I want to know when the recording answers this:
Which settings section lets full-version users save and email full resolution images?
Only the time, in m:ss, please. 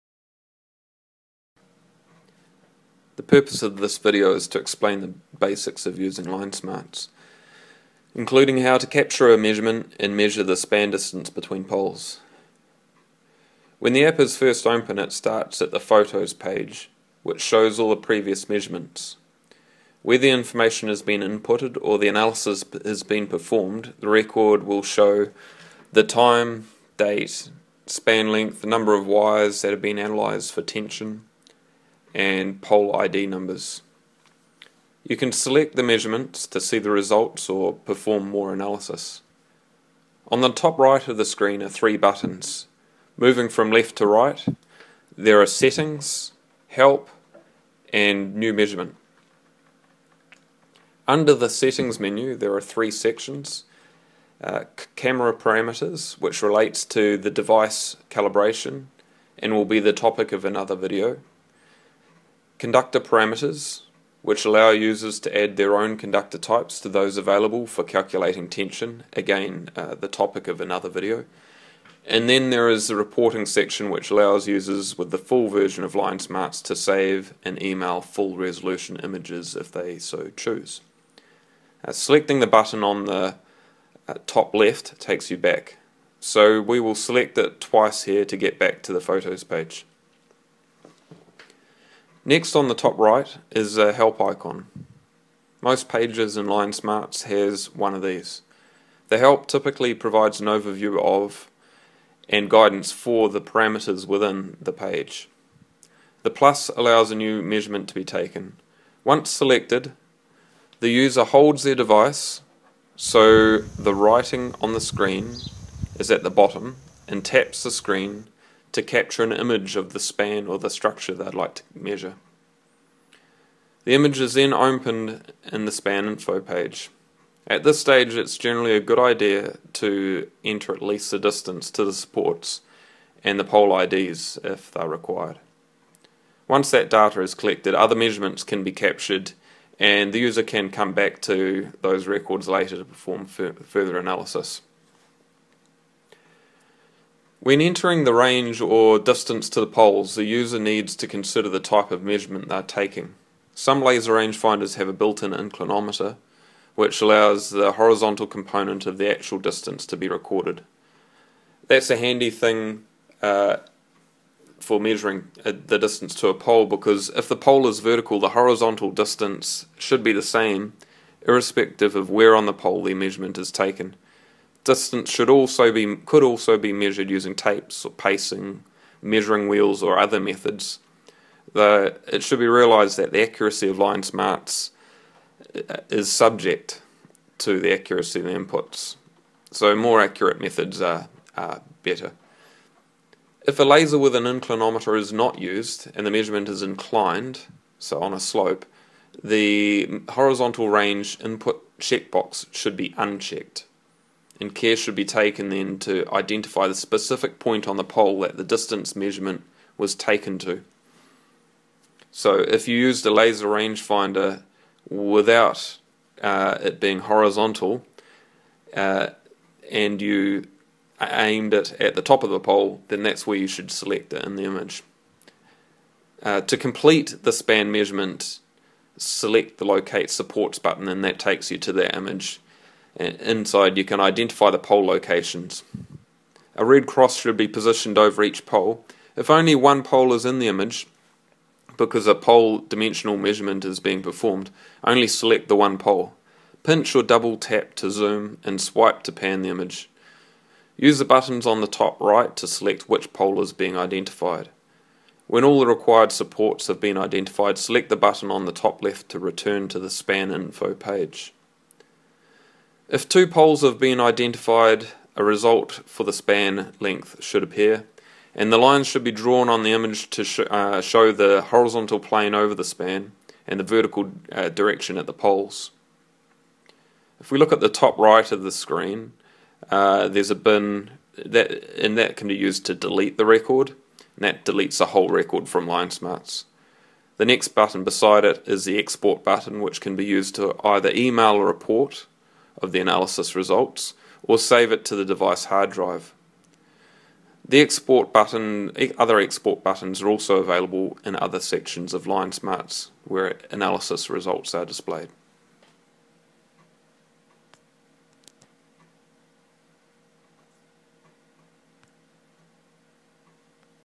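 1:12.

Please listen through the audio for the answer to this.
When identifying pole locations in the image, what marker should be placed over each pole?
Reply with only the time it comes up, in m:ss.
3:56.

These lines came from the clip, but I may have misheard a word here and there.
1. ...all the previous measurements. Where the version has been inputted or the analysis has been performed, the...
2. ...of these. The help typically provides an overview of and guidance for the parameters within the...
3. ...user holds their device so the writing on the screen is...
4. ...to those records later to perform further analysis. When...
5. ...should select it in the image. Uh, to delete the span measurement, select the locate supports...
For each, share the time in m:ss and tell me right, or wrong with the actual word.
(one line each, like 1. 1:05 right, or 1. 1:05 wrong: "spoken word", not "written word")
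1. 0:17 wrong: "information", not "version"
2. 1:37 right
3. 1:50 right
4. 2:21 right
5. 3:43 wrong: "complete", not "delete".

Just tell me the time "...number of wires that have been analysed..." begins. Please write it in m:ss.
0:28.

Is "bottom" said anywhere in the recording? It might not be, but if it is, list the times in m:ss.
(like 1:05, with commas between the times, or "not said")
1:56.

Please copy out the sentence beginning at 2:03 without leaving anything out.
The image is then opened in the span info page.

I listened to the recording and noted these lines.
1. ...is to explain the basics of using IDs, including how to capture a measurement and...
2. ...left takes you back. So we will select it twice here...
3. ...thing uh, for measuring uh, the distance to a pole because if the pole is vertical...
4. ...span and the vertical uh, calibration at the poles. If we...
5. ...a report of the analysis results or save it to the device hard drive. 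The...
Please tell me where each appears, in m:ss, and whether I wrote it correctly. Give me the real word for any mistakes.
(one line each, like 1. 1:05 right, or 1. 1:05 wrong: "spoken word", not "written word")
1. 0:04 wrong: "LineSmarts", not "IDs"
2. 1:24 right
3. 2:42 right
4. 4:32 wrong: "direction", not "calibration"
5. 4:51 right.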